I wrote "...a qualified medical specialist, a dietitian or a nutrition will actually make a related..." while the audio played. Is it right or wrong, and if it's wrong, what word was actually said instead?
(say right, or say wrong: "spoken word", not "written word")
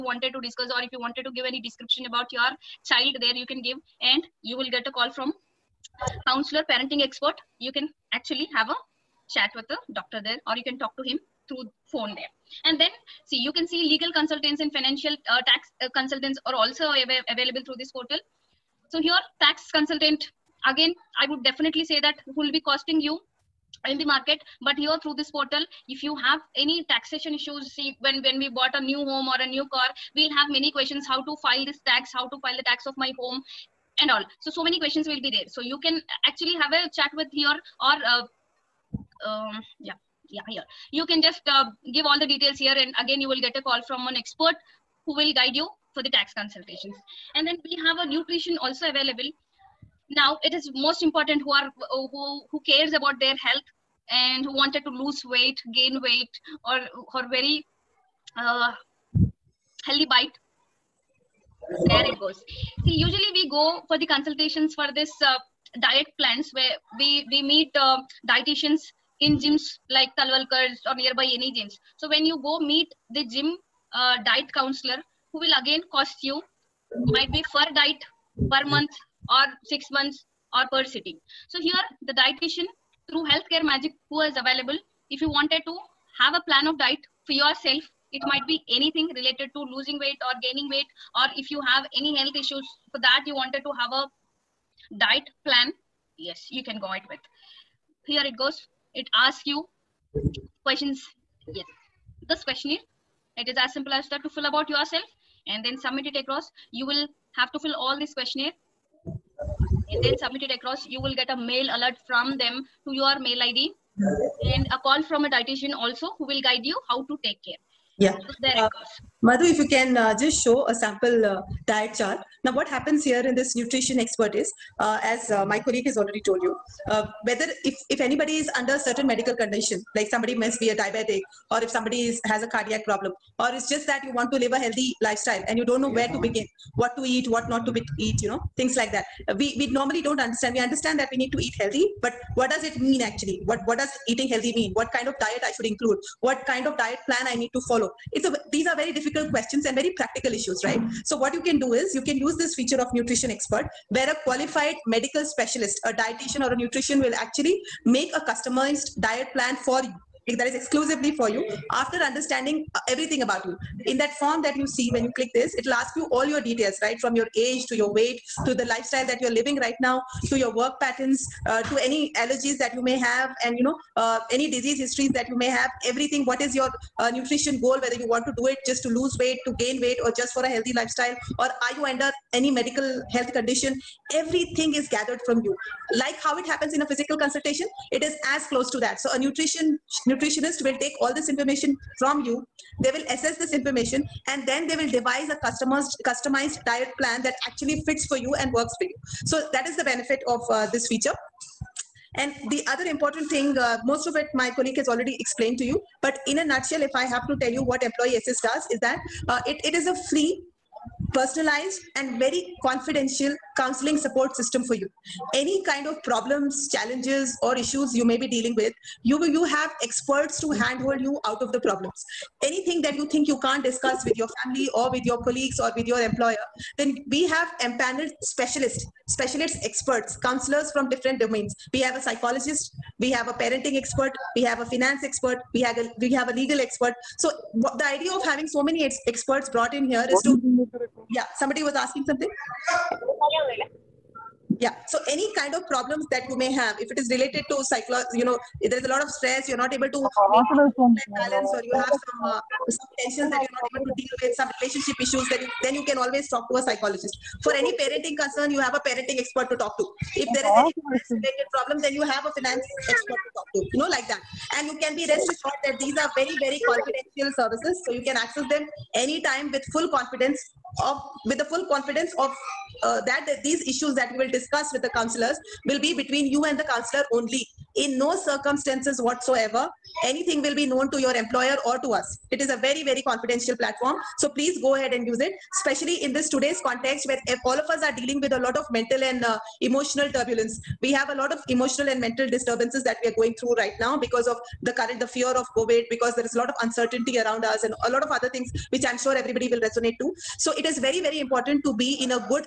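wrong: "customized", not "related".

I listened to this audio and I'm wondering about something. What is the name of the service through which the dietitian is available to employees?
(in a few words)
healthcare magic.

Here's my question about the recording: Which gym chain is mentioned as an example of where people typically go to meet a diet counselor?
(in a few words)
Talwalkar's.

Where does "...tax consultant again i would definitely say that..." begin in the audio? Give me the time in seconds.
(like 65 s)
19 s.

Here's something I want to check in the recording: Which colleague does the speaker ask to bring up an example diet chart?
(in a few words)
Madhu.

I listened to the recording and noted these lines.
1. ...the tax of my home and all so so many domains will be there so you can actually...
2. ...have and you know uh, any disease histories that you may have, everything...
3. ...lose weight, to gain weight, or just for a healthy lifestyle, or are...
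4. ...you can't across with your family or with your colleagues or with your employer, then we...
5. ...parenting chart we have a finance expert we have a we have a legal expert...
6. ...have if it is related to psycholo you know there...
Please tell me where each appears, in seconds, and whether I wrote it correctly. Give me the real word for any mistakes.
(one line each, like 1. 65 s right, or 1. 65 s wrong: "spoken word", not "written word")
1. 32 s wrong: "questions", not "domains"
2. 172 s right
3. 178 s right
4. 223 s wrong: "discuss", not "across"
5. 233 s wrong: "expert", not "chart"
6. 246 s right.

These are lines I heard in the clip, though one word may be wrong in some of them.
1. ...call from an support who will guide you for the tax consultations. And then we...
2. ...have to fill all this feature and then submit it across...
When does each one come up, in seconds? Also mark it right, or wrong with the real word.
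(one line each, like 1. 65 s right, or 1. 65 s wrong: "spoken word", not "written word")
1. 43 s wrong: "expert", not "support"
2. 107 s wrong: "questionnaire", not "feature".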